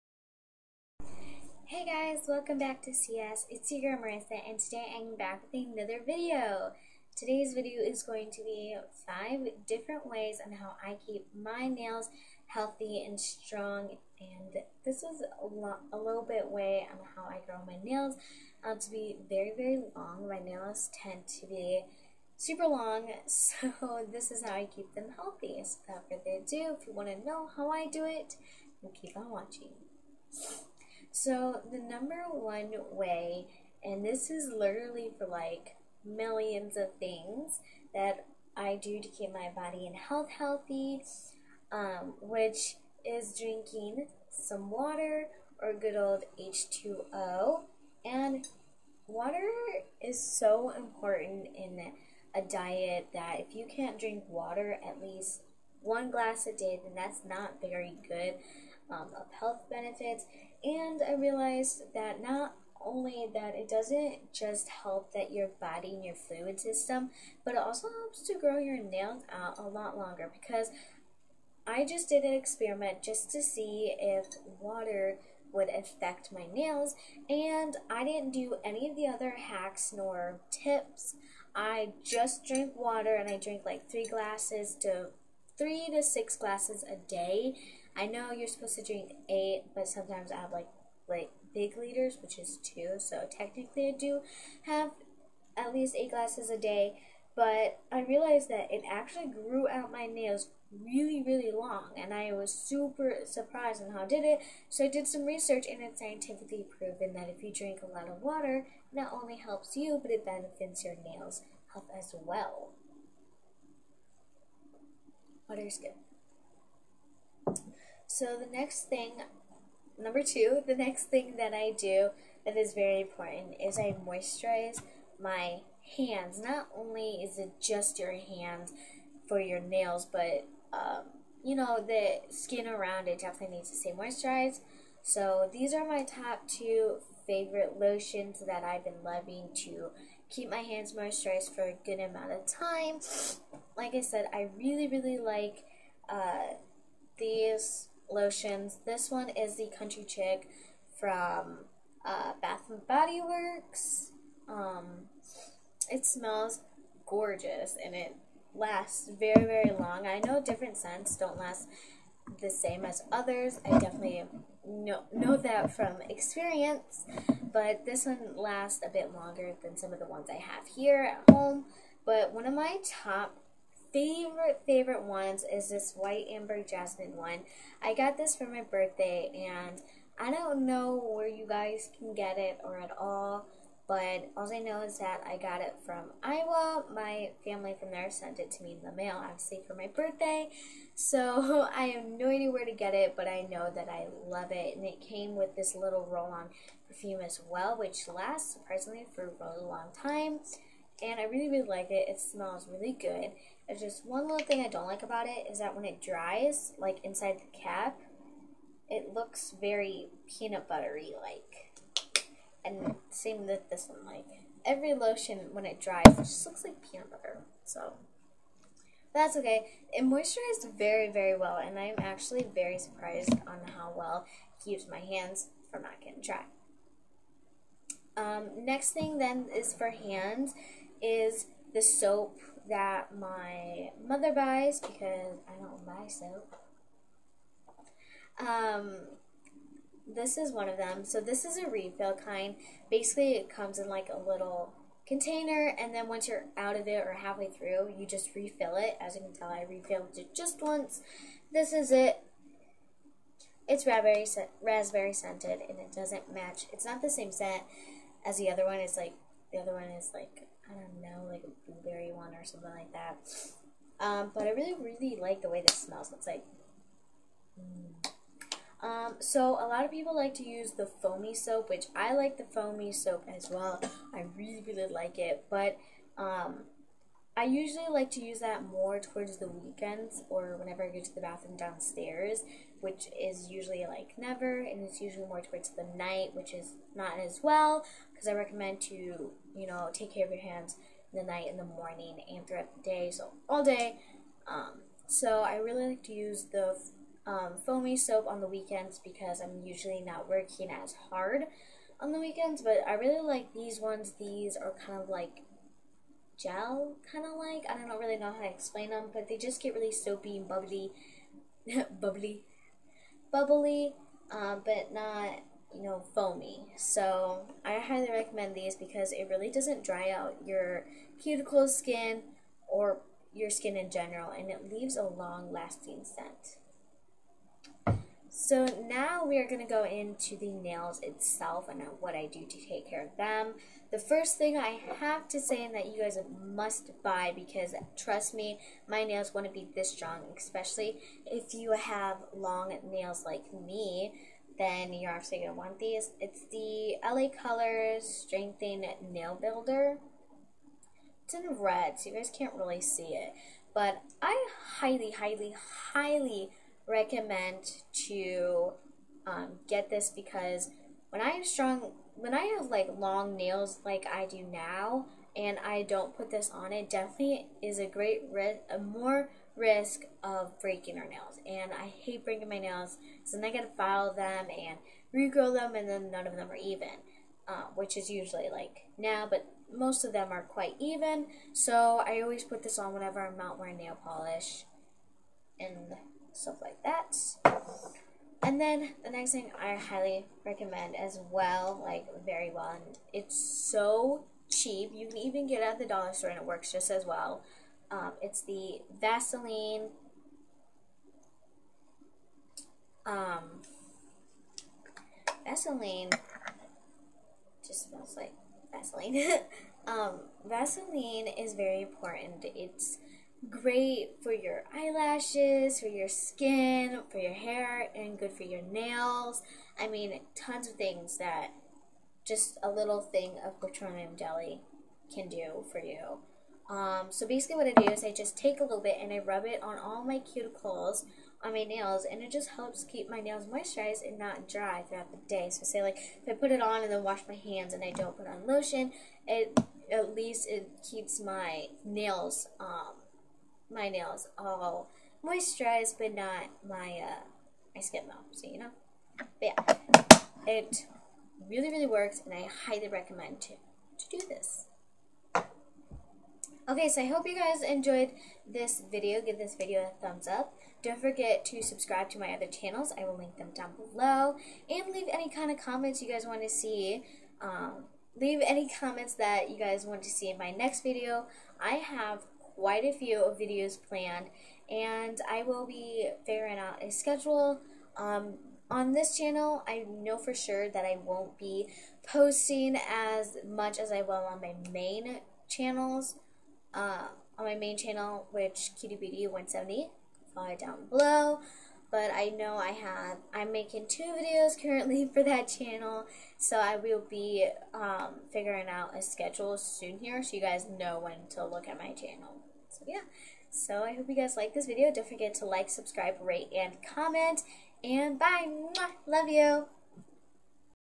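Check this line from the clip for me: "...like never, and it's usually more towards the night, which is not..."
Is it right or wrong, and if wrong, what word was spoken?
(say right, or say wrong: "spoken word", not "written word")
right.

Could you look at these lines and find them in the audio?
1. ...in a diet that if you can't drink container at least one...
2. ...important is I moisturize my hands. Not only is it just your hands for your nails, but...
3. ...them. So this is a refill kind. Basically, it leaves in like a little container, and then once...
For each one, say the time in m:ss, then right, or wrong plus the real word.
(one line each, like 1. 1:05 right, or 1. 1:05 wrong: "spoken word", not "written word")
1. 0:51 wrong: "water", not "container"
2. 2:02 right
3. 4:00 wrong: "comes", not "leaves".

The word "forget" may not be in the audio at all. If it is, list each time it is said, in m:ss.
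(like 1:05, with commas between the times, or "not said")
7:41, 8:25.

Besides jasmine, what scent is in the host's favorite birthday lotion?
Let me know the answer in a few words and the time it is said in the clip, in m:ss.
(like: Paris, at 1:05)
White amber, at 2:55.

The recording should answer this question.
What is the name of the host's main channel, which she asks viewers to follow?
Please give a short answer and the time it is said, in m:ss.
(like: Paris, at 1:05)
Cutiebooty170, at 8:08.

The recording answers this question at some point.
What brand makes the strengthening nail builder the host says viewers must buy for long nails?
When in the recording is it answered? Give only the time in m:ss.
5:47.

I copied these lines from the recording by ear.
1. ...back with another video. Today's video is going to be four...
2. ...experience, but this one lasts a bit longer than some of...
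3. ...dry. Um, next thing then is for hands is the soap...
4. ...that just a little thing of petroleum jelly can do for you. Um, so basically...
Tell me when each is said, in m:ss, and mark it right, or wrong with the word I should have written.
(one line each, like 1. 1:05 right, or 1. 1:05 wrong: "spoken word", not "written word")
1. 0:05 wrong: "five", not "four"
2. 2:46 right
3. 3:46 right
4. 7:01 right.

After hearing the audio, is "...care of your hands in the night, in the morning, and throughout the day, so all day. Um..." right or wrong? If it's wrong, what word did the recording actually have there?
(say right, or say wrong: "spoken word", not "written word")
right.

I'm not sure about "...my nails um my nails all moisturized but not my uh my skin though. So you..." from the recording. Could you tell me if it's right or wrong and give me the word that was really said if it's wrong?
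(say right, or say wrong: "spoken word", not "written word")
right.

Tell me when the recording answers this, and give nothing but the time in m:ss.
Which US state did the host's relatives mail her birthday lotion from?
3:06.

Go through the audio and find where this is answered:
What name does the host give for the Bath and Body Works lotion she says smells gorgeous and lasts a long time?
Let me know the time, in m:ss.
2:29.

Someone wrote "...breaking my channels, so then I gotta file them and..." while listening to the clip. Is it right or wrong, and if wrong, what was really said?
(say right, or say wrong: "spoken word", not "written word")
wrong: "nails", not "channels".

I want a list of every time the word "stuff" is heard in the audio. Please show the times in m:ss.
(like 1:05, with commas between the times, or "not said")
6:26.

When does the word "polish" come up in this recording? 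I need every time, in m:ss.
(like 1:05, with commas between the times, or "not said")
6:24.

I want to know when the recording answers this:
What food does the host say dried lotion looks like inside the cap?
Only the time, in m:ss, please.
3:36.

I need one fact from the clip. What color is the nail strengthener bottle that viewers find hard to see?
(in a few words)
Red.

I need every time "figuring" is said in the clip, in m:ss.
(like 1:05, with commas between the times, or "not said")
7:56, 8:18.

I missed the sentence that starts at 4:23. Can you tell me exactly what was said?
Um, but I really, really like the way this smells.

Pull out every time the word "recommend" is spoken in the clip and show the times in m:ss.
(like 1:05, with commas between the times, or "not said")
4:48, 5:18, 5:56, 6:30, 7:32.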